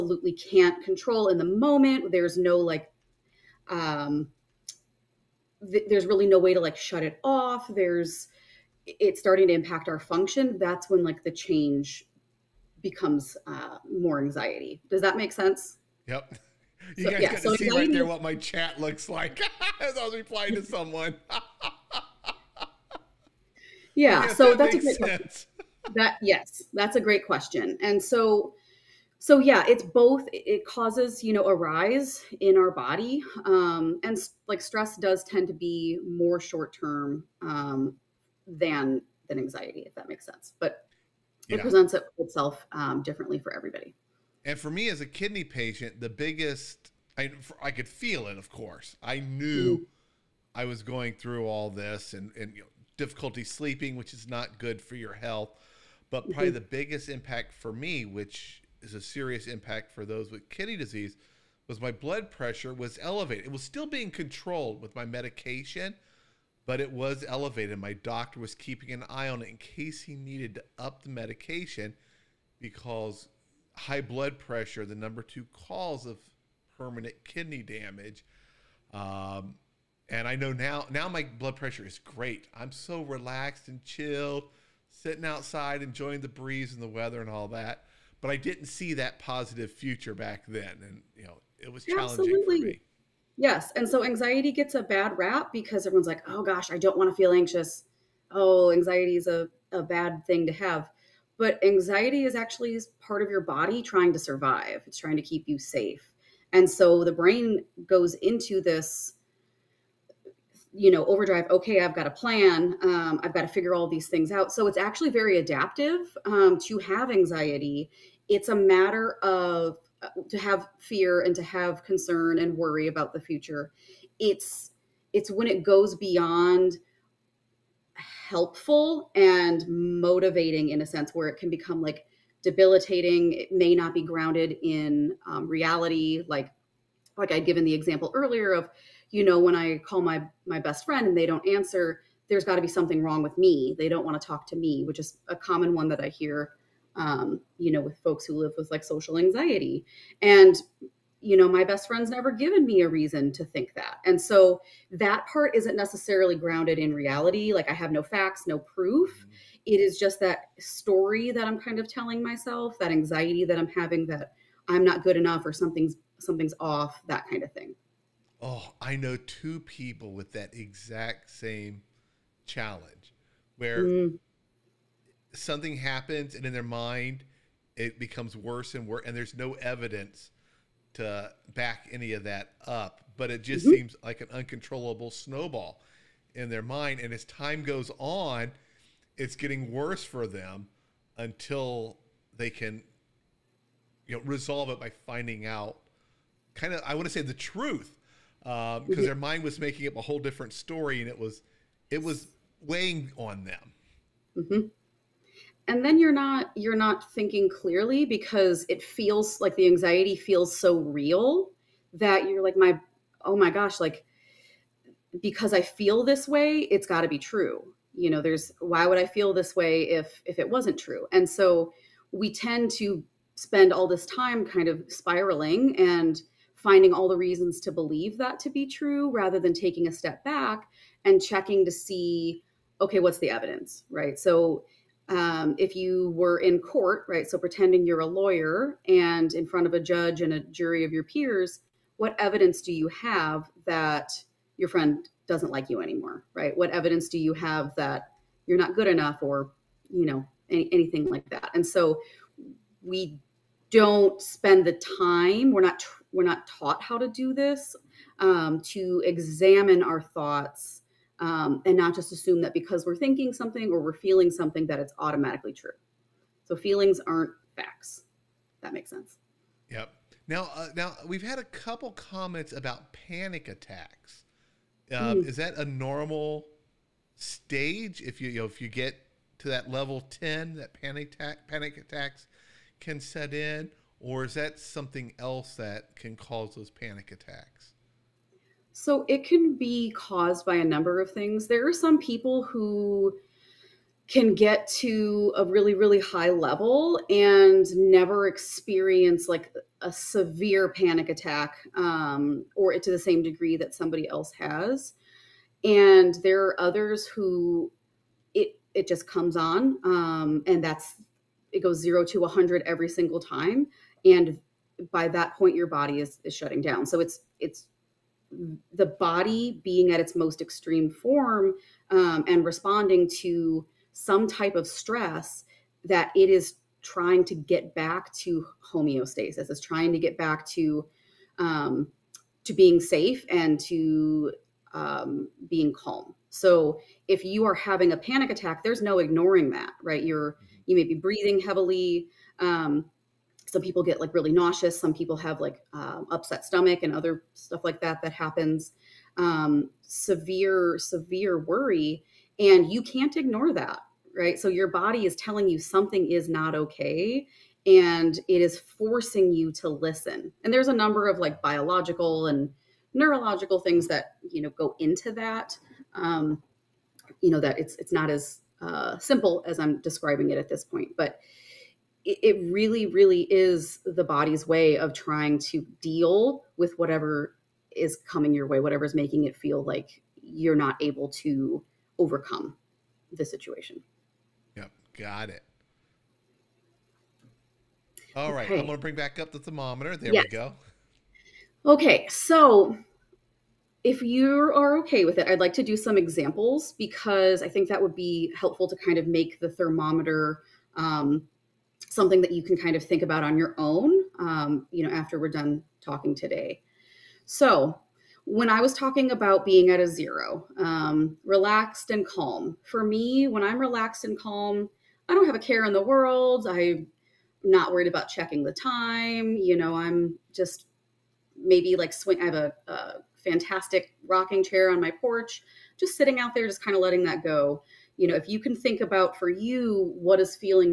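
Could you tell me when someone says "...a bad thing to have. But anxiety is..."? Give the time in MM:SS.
01:39.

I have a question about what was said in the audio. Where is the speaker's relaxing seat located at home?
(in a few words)
porch.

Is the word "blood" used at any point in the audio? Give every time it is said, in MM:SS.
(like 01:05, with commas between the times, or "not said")
01:01, 01:14, 01:21.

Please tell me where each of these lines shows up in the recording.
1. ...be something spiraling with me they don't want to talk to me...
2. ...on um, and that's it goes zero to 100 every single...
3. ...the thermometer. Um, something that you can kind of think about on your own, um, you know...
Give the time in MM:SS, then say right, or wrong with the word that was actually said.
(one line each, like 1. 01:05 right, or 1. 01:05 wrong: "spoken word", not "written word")
1. 02:22 wrong: "wrong", not "spiraling"
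2. 05:09 right
3. 06:39 right.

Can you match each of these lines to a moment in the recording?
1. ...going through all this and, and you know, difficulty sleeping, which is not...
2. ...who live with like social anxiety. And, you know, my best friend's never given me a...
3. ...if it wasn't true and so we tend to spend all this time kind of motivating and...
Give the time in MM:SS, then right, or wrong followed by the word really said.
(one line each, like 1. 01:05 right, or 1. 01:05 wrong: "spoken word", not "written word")
1. 00:50 right
2. 02:28 right
3. 03:40 wrong: "spiraling", not "motivating".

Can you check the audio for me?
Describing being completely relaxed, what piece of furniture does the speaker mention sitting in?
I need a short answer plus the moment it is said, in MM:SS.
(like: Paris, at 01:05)
rocking chair, at 07:04.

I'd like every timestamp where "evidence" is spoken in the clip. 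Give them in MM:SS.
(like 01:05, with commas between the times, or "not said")
02:59, 03:53, 04:02, 04:06.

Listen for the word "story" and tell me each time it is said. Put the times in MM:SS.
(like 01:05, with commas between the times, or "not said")
02:40, 03:20.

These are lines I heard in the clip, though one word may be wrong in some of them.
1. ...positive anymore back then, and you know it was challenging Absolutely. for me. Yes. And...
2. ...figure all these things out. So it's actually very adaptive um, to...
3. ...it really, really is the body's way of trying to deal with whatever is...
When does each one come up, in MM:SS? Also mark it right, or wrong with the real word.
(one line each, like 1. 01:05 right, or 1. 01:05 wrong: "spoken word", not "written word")
1. 01:29 wrong: "future", not "anymore"
2. 01:53 right
3. 06:12 right.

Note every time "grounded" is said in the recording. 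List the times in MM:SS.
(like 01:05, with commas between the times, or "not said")
02:14, 02:36.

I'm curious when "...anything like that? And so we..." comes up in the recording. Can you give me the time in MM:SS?
04:10.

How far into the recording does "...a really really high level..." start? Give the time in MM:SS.
04:55.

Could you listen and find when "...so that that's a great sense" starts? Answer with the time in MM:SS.
00:24.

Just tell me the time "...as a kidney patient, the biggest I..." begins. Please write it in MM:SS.
00:44.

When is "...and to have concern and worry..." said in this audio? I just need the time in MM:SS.
02:01.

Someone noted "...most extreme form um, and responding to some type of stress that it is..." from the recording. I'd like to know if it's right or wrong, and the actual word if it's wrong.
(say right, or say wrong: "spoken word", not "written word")
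right.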